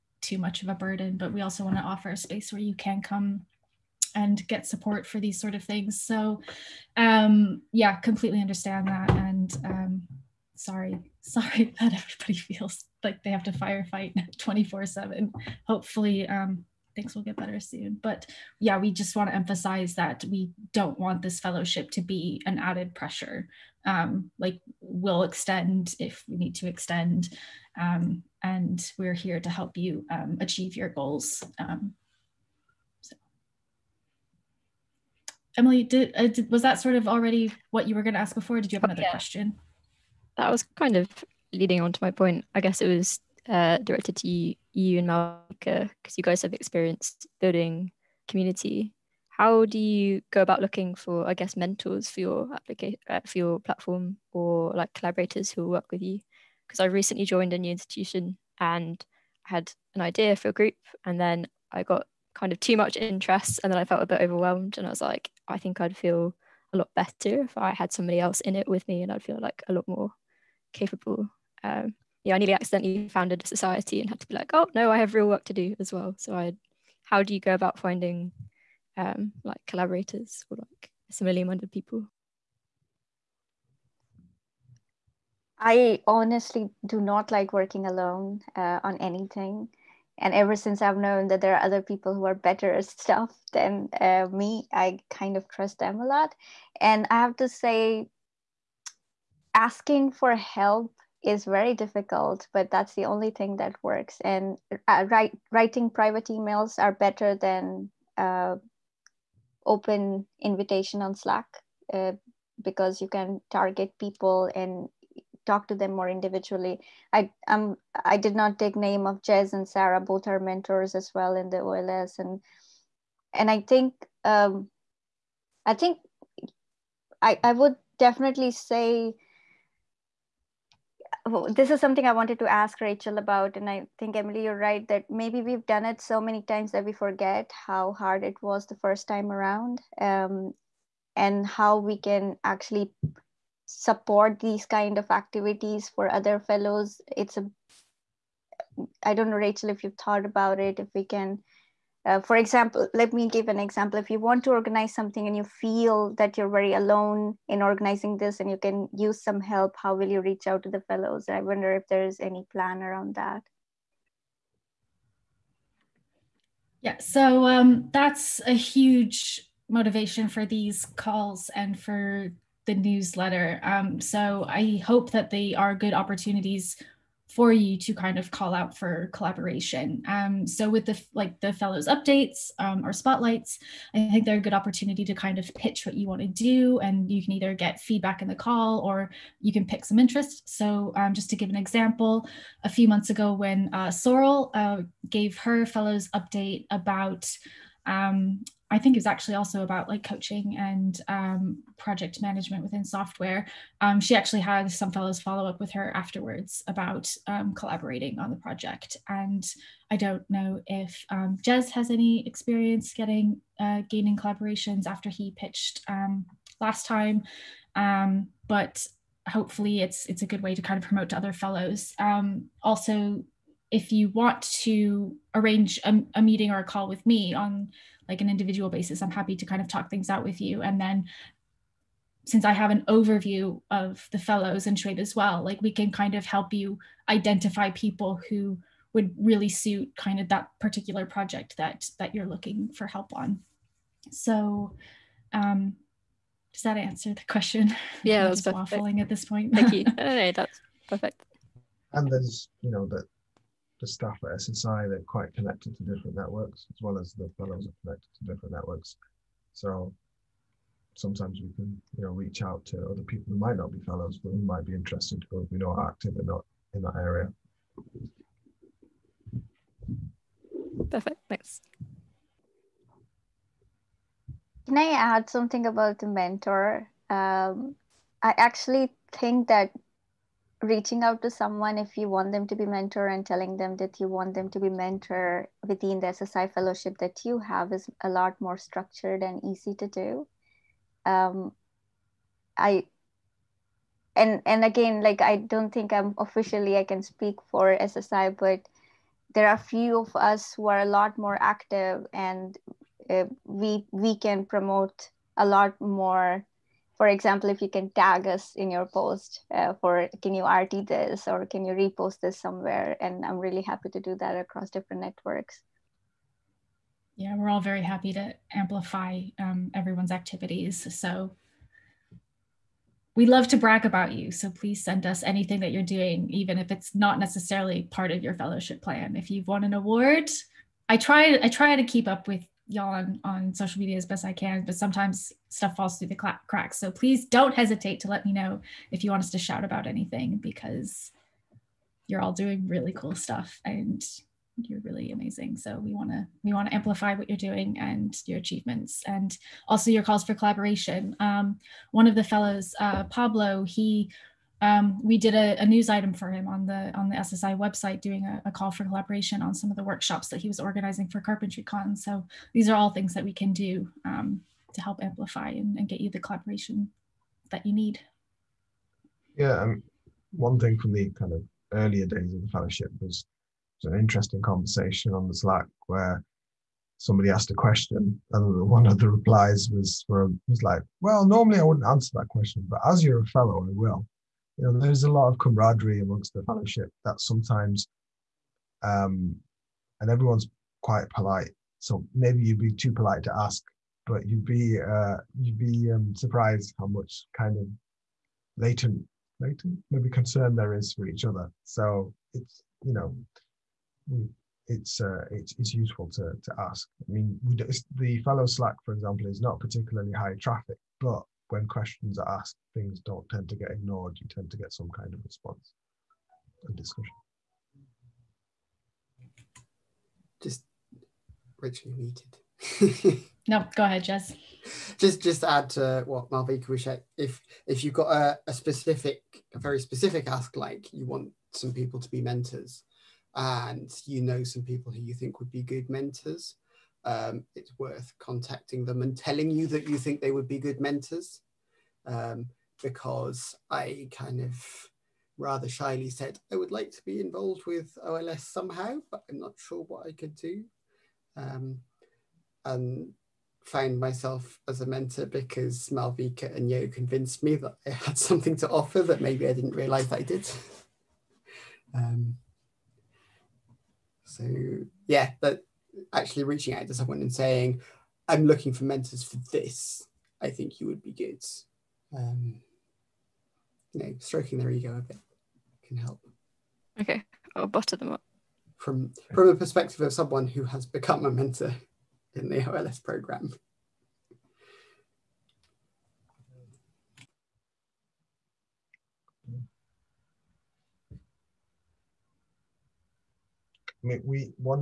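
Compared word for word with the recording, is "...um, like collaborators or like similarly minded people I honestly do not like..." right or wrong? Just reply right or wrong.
right.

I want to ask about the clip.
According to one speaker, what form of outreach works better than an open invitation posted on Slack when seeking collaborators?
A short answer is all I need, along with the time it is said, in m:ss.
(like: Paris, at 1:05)
private emails, at 1:45.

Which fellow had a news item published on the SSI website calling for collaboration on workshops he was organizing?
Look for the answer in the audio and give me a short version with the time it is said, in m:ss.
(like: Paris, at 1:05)
Pablo, at 5:53.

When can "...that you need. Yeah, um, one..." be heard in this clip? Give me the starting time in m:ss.
6:07.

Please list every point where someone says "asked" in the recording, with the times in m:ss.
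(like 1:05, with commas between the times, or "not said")
6:17, 6:52.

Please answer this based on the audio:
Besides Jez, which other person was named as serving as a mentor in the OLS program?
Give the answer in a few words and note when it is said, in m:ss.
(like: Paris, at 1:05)
Sarah, at 1:59.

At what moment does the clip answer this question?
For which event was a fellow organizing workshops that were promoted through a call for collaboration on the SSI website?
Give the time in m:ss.
6:01.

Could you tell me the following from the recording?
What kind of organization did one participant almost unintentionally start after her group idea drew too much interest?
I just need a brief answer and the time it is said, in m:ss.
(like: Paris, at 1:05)
a society, at 1:13.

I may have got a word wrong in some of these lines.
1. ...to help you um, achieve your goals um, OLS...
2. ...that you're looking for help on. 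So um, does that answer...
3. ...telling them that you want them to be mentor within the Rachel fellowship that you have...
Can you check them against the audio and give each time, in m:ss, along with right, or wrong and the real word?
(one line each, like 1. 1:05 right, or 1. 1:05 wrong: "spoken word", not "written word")
1. 0:29 wrong: "Emily", not "OLS"
2. 4:01 right
3. 4:43 wrong: "SSI", not "Rachel".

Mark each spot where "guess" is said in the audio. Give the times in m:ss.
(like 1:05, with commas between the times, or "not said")
0:42, 0:51.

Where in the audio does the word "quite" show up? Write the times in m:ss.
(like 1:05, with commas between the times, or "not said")
4:15, 6:30.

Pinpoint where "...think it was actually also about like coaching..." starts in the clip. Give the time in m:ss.
3:18.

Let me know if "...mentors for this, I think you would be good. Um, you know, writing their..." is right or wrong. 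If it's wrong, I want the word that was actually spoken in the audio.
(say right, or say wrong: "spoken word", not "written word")
wrong: "stroking", not "writing".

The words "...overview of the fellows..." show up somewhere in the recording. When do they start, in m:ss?
3:52.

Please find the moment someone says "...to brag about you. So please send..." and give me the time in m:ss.
5:23.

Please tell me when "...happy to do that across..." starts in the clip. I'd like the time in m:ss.
5:13.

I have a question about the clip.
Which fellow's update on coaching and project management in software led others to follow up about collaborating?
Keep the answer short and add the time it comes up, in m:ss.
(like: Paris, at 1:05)
Sorrel, at 3:13.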